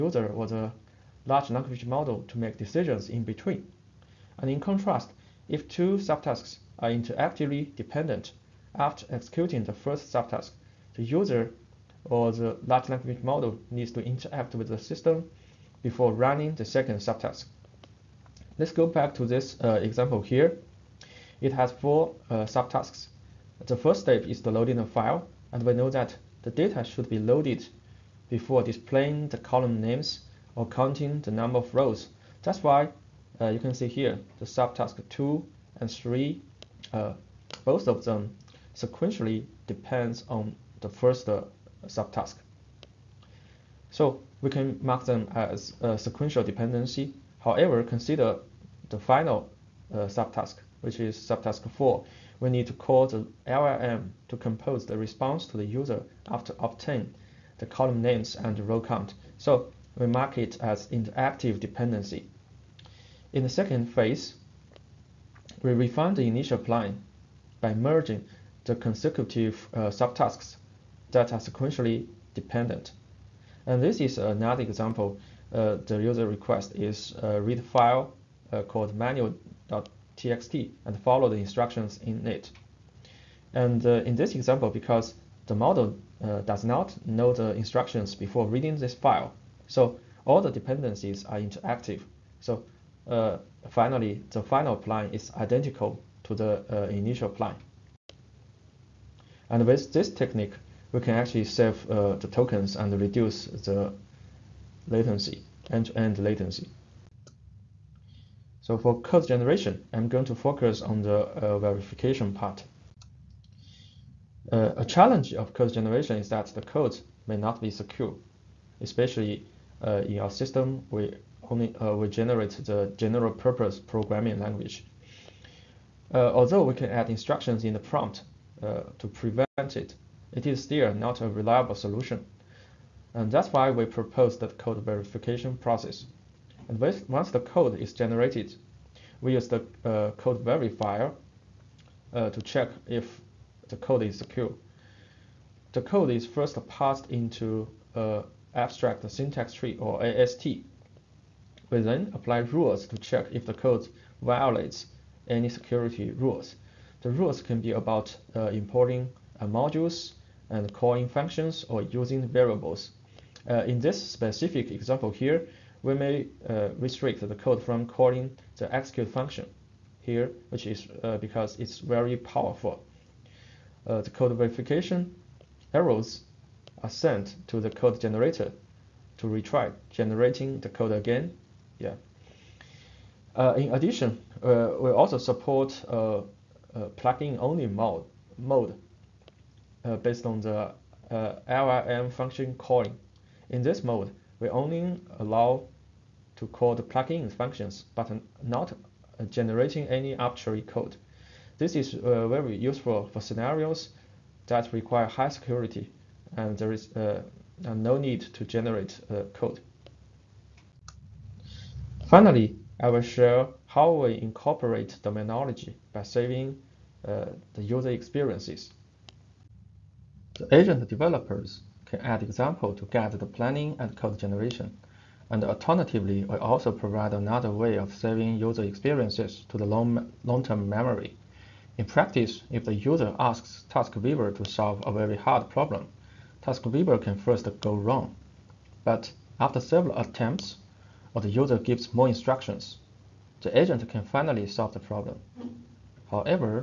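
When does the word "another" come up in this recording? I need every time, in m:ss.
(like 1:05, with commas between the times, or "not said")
1:14, 3:47.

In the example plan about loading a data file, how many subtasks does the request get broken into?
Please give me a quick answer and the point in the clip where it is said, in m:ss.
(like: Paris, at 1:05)
4, at 0:21.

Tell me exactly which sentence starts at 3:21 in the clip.
This is uh, very useful for scenarios that require high security and there is uh, no need to generate uh, code.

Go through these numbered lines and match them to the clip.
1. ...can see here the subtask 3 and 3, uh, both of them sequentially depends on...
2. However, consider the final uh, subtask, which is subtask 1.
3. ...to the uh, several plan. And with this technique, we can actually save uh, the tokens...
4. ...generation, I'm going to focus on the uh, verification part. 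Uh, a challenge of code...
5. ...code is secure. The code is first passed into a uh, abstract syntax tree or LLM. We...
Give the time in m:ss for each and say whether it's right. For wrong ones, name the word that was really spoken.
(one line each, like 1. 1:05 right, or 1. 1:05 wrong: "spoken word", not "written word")
1. 0:33 wrong: "2", not "3"
2. 0:47 wrong: "4", not "1"
3. 1:36 wrong: "initial", not "several"
4. 1:49 right
5. 2:23 wrong: "AST", not "LLM".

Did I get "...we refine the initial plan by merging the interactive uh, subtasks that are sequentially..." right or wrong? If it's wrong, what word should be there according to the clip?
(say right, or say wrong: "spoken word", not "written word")
wrong: "consecutive", not "interactive".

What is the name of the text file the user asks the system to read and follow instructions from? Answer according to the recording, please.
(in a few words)
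manual.txt.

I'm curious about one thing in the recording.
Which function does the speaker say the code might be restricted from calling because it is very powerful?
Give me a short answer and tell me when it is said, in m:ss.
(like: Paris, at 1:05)
execute, at 2:48.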